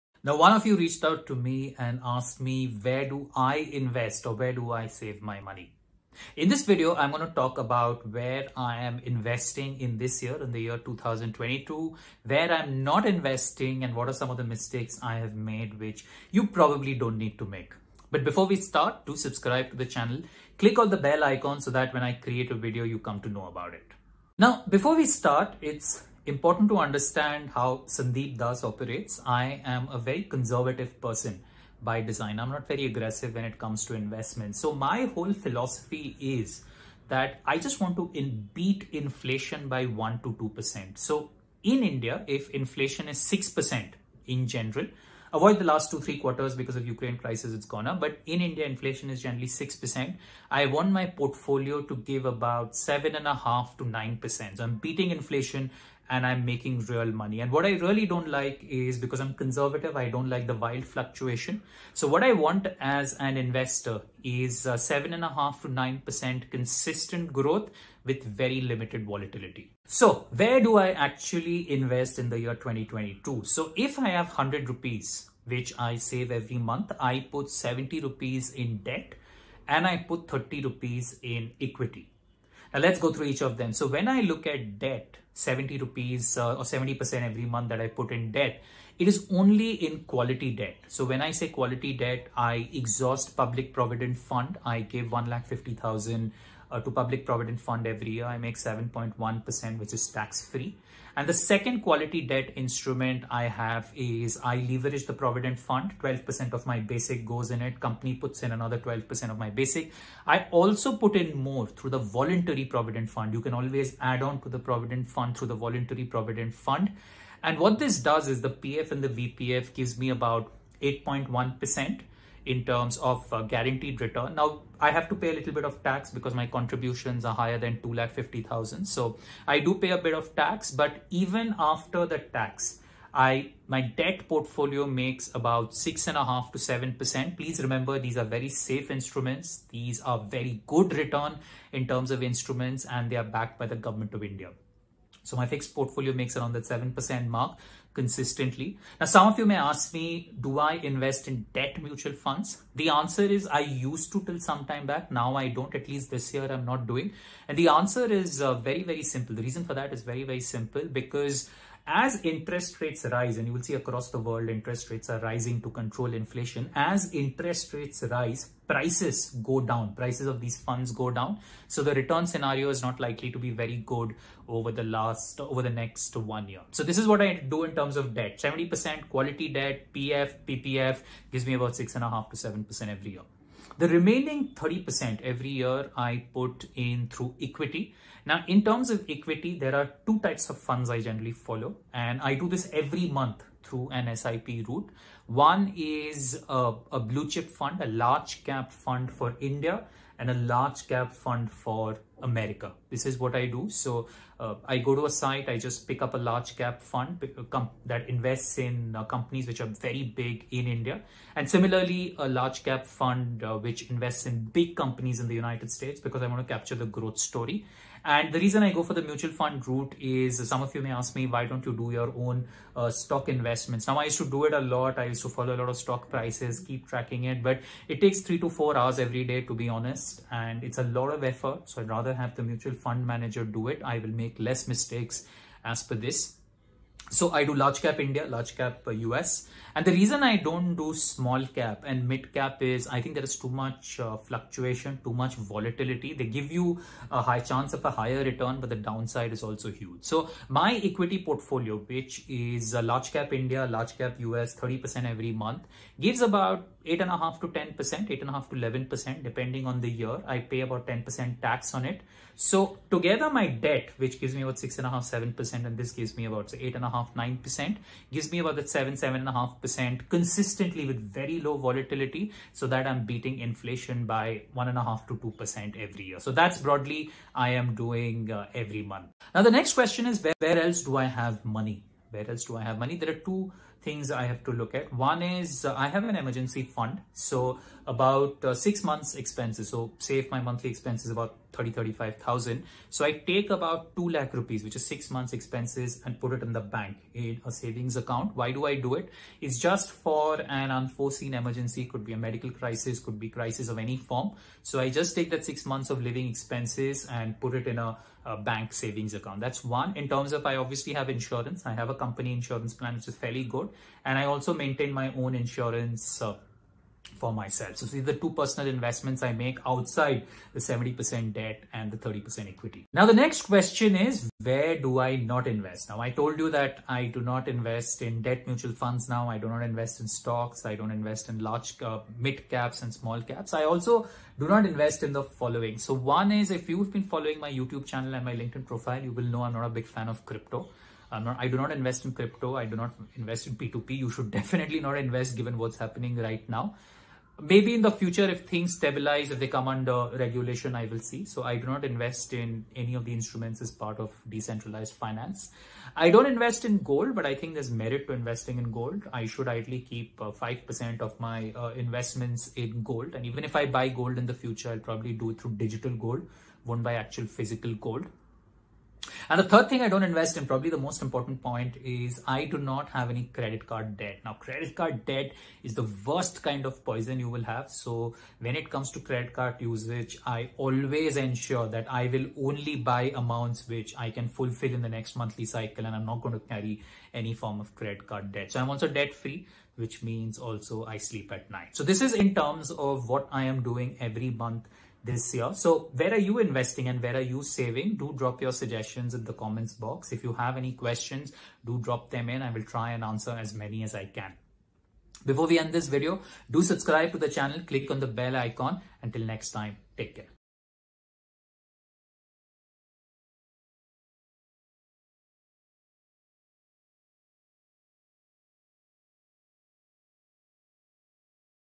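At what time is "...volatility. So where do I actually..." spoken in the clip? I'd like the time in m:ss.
1:09.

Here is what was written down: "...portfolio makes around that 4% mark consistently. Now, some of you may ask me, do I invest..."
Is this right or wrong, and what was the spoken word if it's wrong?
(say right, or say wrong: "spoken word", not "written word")
wrong: "7", not "4".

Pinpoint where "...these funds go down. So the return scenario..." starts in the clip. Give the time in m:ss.
2:50.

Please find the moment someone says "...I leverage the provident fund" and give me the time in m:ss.
1:44.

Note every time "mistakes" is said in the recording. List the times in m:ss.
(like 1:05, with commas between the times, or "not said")
0:14, 3:54.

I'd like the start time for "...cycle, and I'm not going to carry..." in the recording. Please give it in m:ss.
6:25.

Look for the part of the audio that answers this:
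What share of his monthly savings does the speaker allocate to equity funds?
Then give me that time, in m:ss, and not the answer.
1:20.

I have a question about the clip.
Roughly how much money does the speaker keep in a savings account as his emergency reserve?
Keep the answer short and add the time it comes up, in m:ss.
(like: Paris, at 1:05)
2 lakh rupees, at 4:53.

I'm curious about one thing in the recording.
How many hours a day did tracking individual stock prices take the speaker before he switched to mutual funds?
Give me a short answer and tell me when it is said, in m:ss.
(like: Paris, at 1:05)
3 to 4 hours, at 3:48.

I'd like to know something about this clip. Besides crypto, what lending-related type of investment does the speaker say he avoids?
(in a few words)
P2P.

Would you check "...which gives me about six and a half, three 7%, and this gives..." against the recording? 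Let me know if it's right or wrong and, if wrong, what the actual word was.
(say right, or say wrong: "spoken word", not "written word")
wrong: "seven", not "three".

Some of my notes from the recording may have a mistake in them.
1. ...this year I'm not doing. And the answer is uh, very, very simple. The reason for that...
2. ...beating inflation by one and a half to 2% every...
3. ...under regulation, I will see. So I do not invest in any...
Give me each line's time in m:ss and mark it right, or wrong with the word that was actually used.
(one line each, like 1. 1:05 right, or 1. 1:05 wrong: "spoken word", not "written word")
1. 2:36 right
2. 4:33 right
3. 5:49 right.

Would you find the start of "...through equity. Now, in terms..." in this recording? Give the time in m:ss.
3:07.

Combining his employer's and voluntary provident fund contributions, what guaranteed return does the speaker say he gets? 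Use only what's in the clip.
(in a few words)
8.1%.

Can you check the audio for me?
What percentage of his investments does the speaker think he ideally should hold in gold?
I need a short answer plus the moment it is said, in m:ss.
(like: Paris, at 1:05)
5%, at 6:00.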